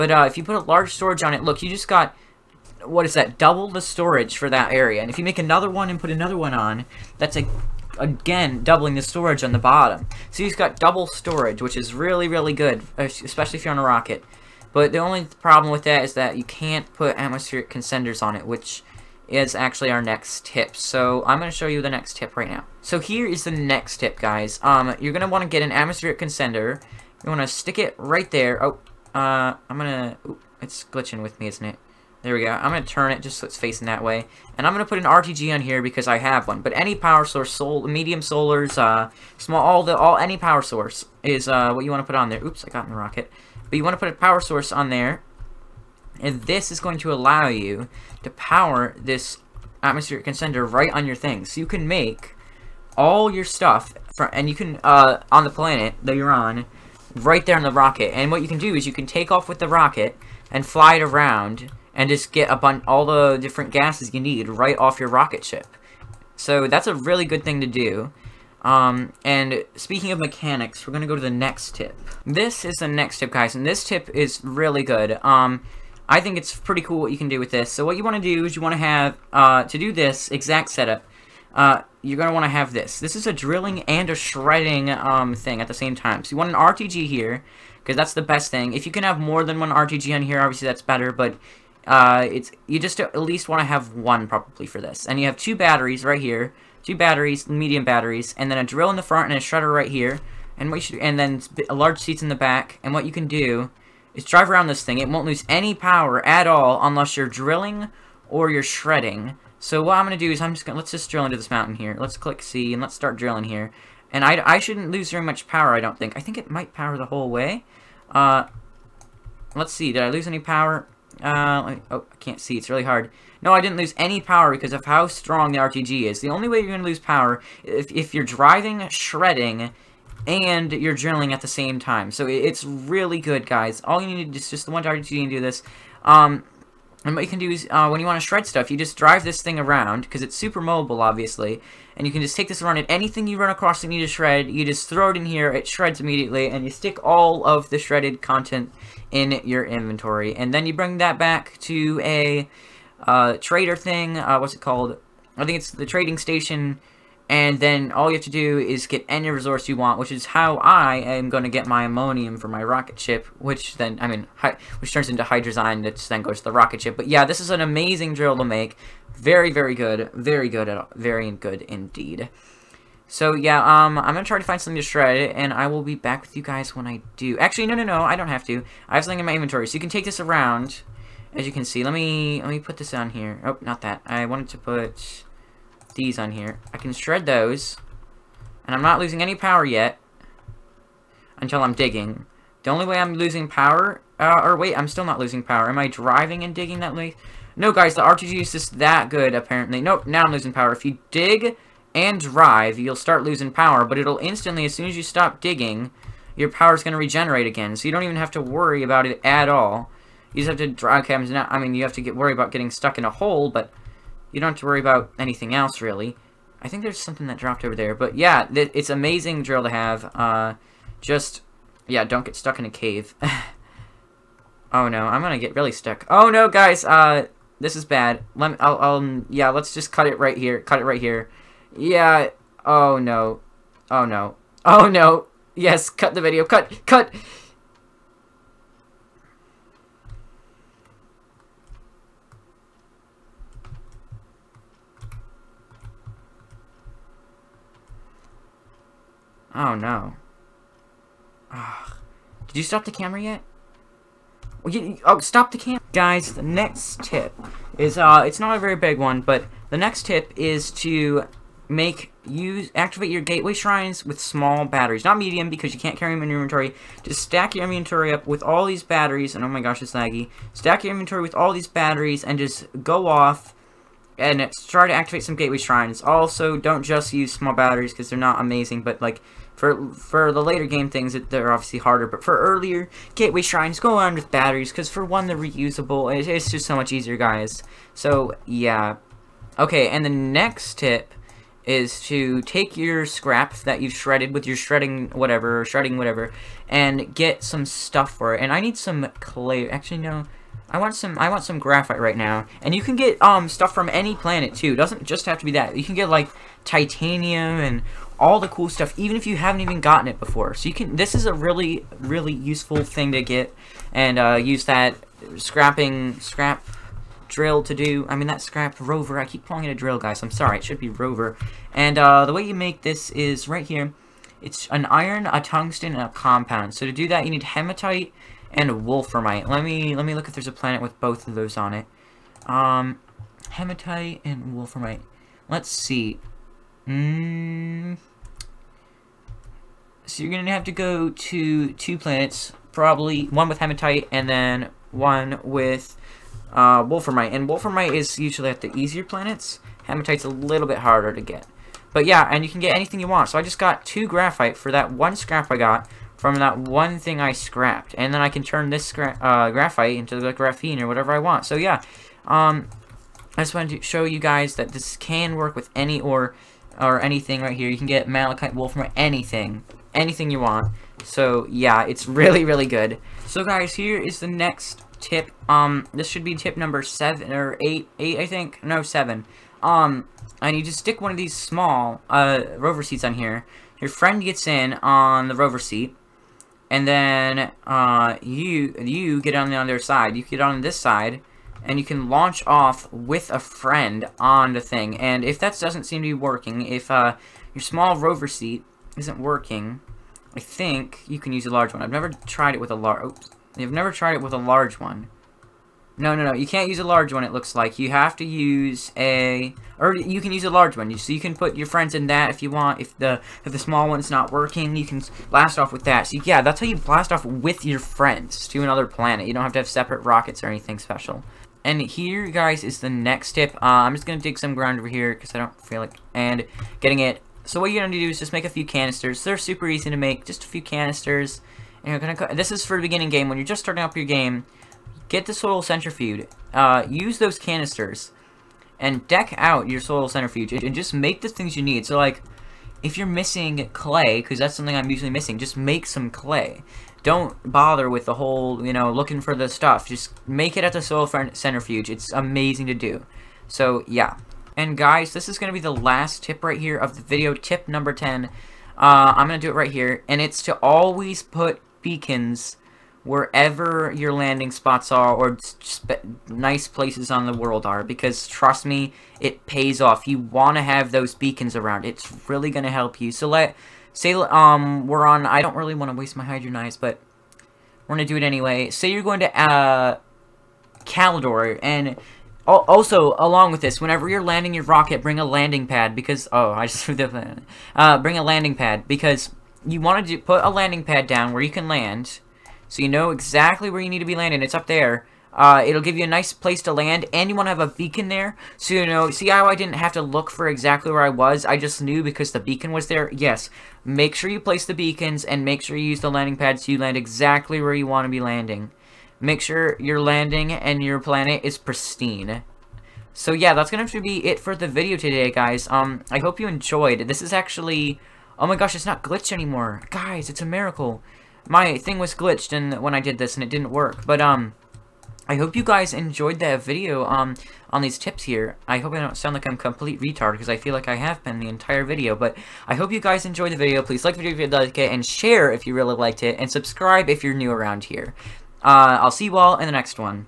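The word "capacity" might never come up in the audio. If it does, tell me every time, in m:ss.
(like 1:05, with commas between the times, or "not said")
not said.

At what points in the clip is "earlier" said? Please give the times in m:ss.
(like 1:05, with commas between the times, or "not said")
4:42.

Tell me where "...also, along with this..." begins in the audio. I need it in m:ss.
8:02.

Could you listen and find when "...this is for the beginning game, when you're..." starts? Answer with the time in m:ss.
7:12.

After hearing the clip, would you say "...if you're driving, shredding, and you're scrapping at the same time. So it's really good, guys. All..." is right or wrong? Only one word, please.
wrong.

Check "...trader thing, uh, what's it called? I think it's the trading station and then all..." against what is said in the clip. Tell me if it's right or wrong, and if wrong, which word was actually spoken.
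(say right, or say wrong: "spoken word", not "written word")
right.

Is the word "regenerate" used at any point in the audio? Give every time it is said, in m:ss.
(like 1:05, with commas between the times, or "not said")
3:26.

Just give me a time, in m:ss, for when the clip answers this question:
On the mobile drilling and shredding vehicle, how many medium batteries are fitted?
1:36.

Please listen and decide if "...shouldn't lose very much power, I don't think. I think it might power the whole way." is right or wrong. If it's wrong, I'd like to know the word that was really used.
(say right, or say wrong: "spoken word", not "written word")
right.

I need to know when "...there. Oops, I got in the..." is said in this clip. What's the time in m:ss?
0:42.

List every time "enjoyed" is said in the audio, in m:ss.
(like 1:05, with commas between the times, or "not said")
8:36, 8:45, 8:53.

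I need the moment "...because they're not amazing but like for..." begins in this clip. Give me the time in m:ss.
4:37.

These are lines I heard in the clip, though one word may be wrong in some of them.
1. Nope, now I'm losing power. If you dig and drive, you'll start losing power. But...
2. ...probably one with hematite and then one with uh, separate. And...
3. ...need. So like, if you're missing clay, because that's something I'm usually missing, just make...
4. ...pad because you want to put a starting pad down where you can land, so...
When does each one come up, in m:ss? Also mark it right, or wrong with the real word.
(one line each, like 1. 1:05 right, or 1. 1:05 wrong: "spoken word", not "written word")
1. 3:19 right
2. 5:42 wrong: "wolframite", not "separate"
3. 7:21 right
4. 8:08 wrong: "landing", not "starting".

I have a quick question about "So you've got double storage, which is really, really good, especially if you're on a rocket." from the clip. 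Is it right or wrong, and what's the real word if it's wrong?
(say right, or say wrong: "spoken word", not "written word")
right.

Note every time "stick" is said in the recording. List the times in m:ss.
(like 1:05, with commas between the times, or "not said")
0:27, 2:26, 6:20.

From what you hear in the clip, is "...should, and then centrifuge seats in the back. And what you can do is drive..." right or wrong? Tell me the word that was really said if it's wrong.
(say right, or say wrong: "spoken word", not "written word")
wrong: "large", not "centrifuge".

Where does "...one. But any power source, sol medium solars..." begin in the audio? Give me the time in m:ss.
0:36.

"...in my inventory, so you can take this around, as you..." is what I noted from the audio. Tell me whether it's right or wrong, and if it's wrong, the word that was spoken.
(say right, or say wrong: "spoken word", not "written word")
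right.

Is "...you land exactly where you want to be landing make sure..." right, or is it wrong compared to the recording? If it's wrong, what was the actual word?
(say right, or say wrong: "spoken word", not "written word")
right.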